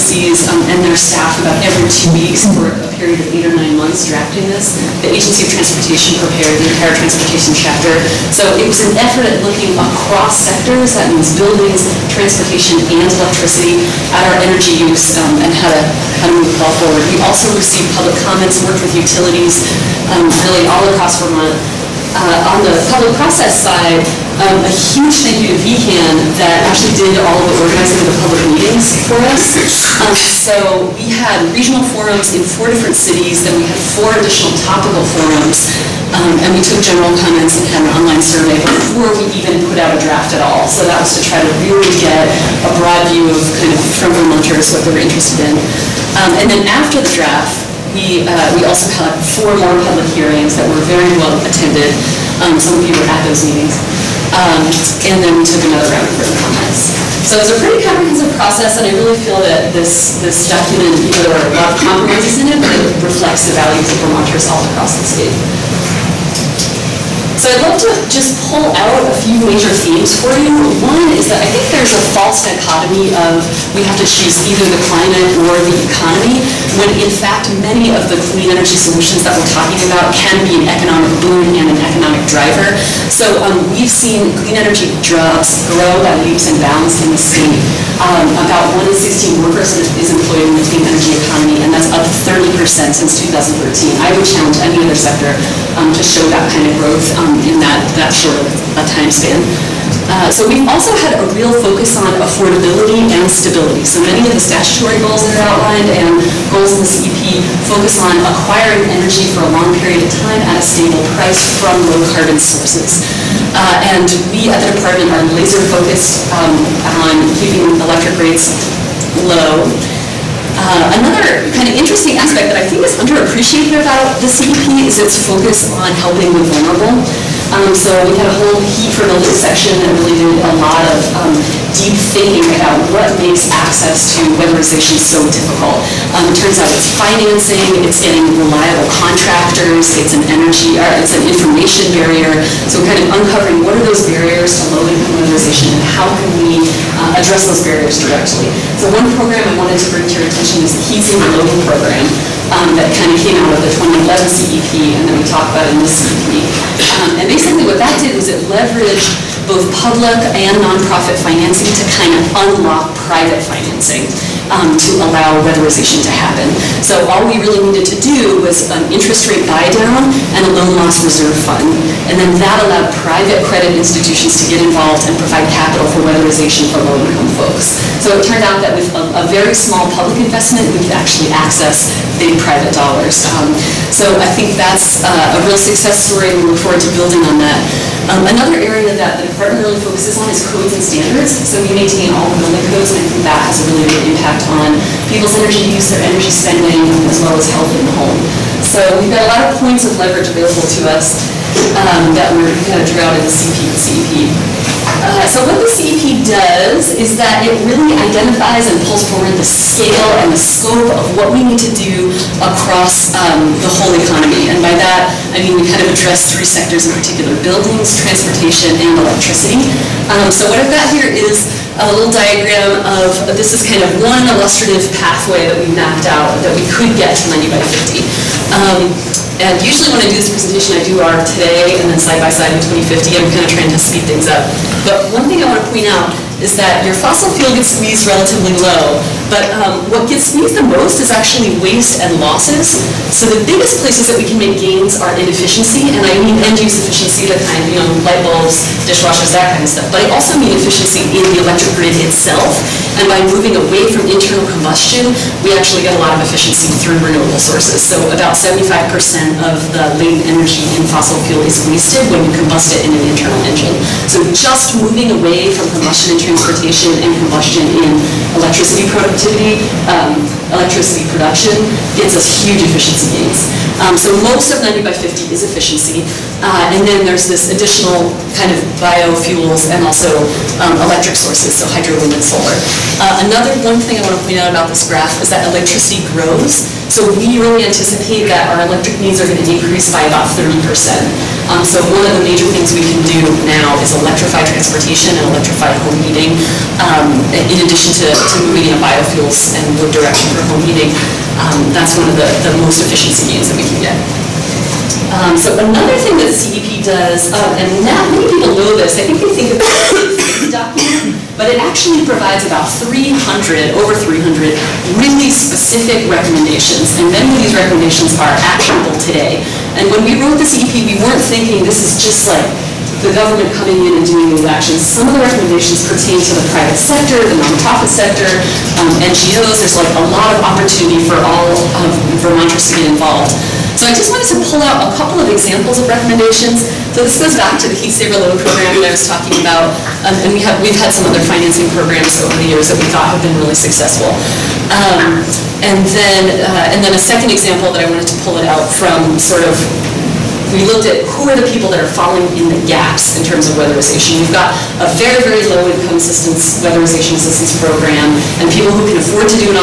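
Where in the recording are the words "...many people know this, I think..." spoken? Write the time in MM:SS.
05:08.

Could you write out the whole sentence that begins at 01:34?
I would challenge any other sector um, to show that kind of growth um, in that, that sort time span.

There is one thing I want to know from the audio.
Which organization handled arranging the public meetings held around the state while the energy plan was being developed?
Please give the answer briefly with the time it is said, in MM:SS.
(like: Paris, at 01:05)
VCAN, at 00:25.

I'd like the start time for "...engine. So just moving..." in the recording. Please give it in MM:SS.
04:23.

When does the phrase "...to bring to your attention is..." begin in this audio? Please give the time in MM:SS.
02:29.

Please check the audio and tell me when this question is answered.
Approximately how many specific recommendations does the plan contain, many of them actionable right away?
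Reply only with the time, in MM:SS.
05:13.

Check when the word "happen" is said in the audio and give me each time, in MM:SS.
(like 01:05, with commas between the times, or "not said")
02:46.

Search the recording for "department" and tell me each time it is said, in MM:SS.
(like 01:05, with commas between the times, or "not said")
01:54, 03:09.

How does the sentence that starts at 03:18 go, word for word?
So we've got a lot of points of leverage available to us um, that we're going to drawing out in the CEP.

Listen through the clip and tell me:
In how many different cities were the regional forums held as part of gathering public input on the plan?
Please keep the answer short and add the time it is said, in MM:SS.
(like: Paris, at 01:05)
4, at 00:32.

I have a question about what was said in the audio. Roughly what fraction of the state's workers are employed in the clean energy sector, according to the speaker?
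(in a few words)
1 in 16.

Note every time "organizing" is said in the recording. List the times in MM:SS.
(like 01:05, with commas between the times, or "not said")
00:27.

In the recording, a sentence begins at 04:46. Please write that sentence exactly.
So we really anticipate that our electric needs are going to decrease by about 30%.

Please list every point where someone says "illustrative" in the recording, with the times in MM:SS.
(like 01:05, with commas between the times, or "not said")
03:44.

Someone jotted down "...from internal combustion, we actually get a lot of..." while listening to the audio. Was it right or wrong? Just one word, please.
right.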